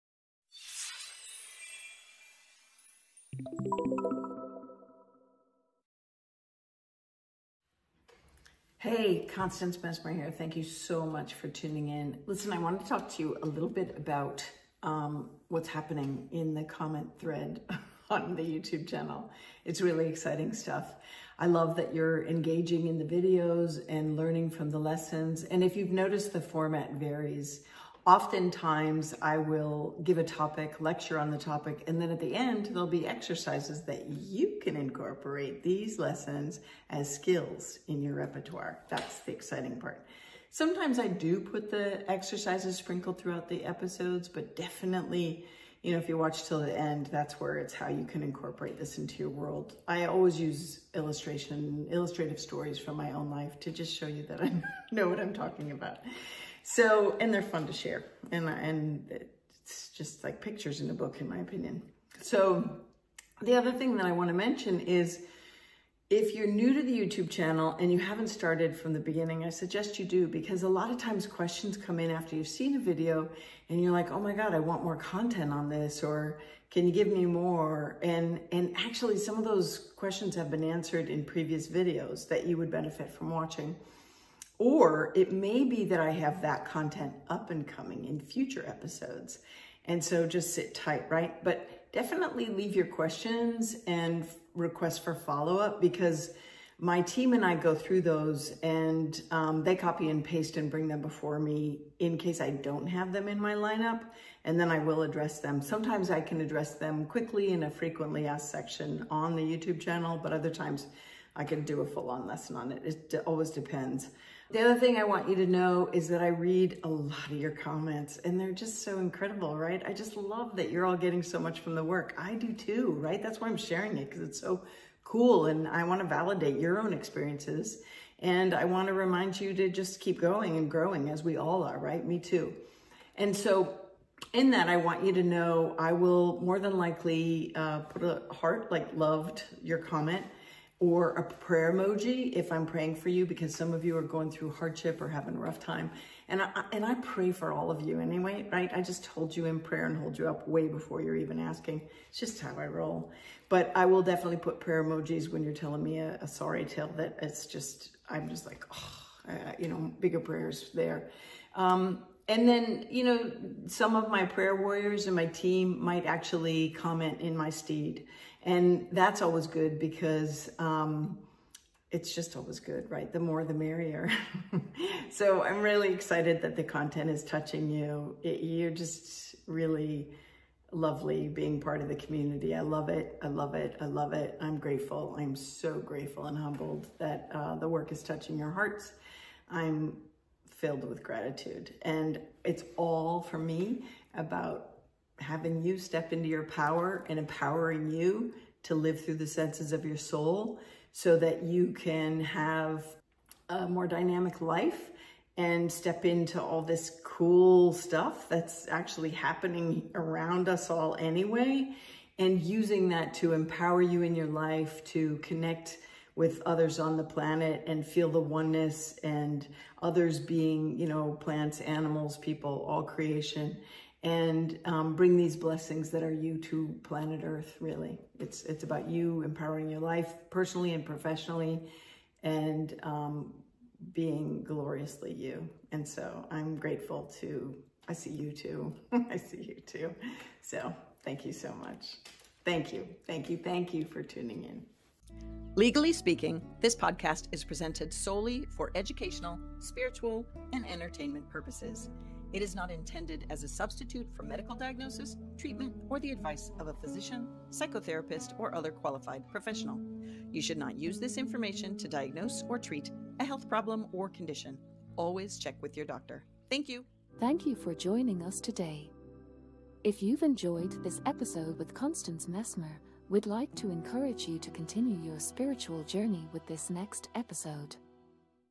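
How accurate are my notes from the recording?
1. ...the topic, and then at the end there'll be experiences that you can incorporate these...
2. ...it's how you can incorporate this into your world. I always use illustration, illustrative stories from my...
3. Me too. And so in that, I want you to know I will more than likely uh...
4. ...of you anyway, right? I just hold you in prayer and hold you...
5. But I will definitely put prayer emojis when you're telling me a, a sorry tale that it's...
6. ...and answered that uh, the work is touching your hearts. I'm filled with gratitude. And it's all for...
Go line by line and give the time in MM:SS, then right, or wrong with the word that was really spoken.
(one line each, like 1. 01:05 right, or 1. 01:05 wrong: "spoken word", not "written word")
1. 00:31 wrong: "exercises", not "experiences"
2. 00:47 right
3. 02:12 right
4. 02:27 right
5. 02:33 right
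6. 03:06 wrong: "humbled", not "answered".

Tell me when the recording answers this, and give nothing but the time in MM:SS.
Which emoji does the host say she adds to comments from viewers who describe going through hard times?
02:21.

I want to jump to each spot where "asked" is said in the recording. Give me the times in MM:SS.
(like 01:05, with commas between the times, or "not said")
01:48.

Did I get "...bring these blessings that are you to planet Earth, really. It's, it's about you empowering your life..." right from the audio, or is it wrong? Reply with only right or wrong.
right.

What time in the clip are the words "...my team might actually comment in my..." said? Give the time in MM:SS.
02:45.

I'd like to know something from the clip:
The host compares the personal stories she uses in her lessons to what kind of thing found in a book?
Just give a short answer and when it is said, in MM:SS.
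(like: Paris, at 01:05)
Pictures, at 01:00.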